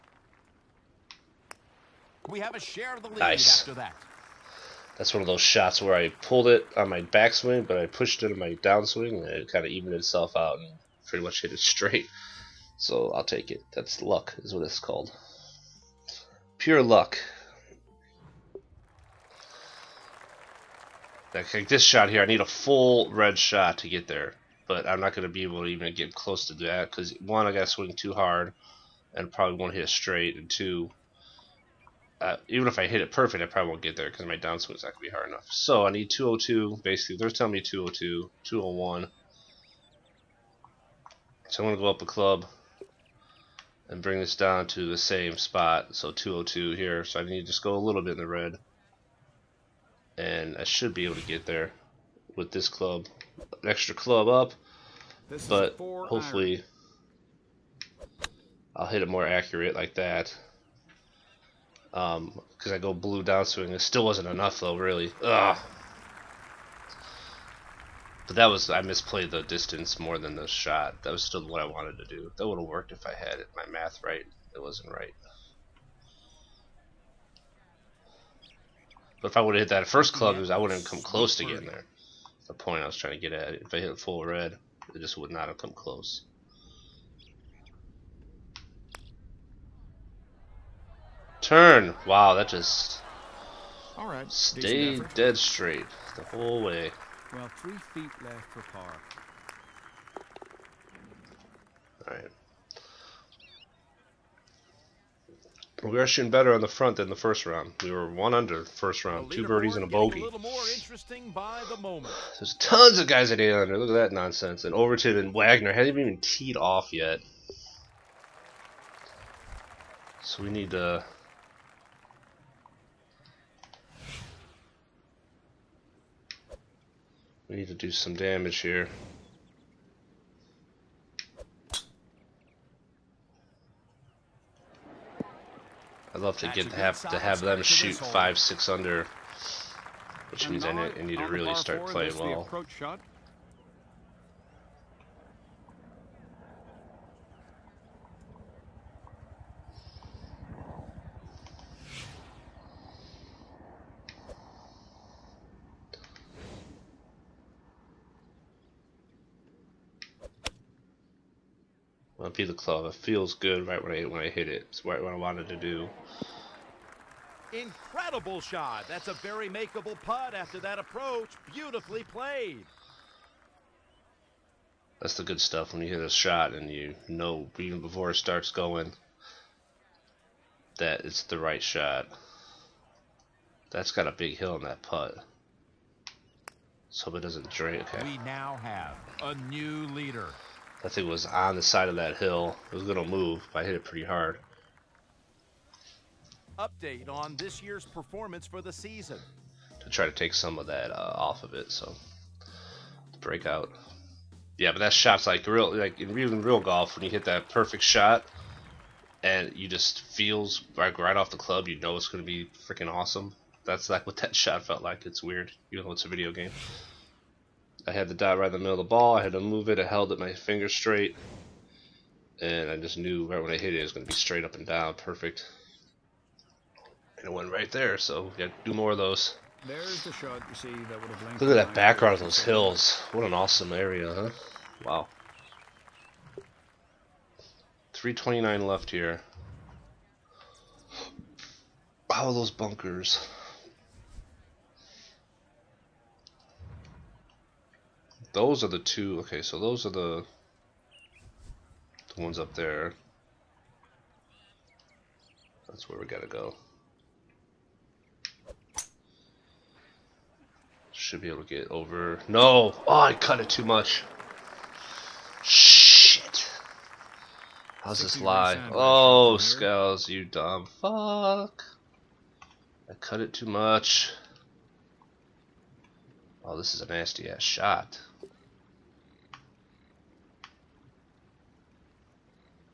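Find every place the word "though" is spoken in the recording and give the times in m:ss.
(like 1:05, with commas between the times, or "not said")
1:04, 3:35.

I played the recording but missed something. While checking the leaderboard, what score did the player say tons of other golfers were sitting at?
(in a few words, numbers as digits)
eight under.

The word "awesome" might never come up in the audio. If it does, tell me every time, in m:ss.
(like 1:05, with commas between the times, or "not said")
3:32, 3:53.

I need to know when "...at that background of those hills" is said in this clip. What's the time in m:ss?
3:51.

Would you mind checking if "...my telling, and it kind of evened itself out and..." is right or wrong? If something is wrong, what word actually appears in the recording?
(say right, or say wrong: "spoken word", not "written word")
wrong: "downswing", not "telling".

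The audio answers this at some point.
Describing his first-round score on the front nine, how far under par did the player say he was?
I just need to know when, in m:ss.
1:48.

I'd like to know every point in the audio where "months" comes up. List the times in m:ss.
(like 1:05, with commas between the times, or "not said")
not said.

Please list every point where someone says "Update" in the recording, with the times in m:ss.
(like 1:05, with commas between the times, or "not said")
3:16.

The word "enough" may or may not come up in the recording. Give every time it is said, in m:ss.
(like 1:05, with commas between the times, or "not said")
0:35, 1:04.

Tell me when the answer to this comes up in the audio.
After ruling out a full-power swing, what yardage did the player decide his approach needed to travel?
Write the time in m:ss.
0:36.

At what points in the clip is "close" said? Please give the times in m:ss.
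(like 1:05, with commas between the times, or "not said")
0:26, 1:21, 1:25.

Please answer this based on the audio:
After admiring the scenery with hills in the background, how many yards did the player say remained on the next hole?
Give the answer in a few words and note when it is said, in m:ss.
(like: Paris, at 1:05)
329, at 3:57.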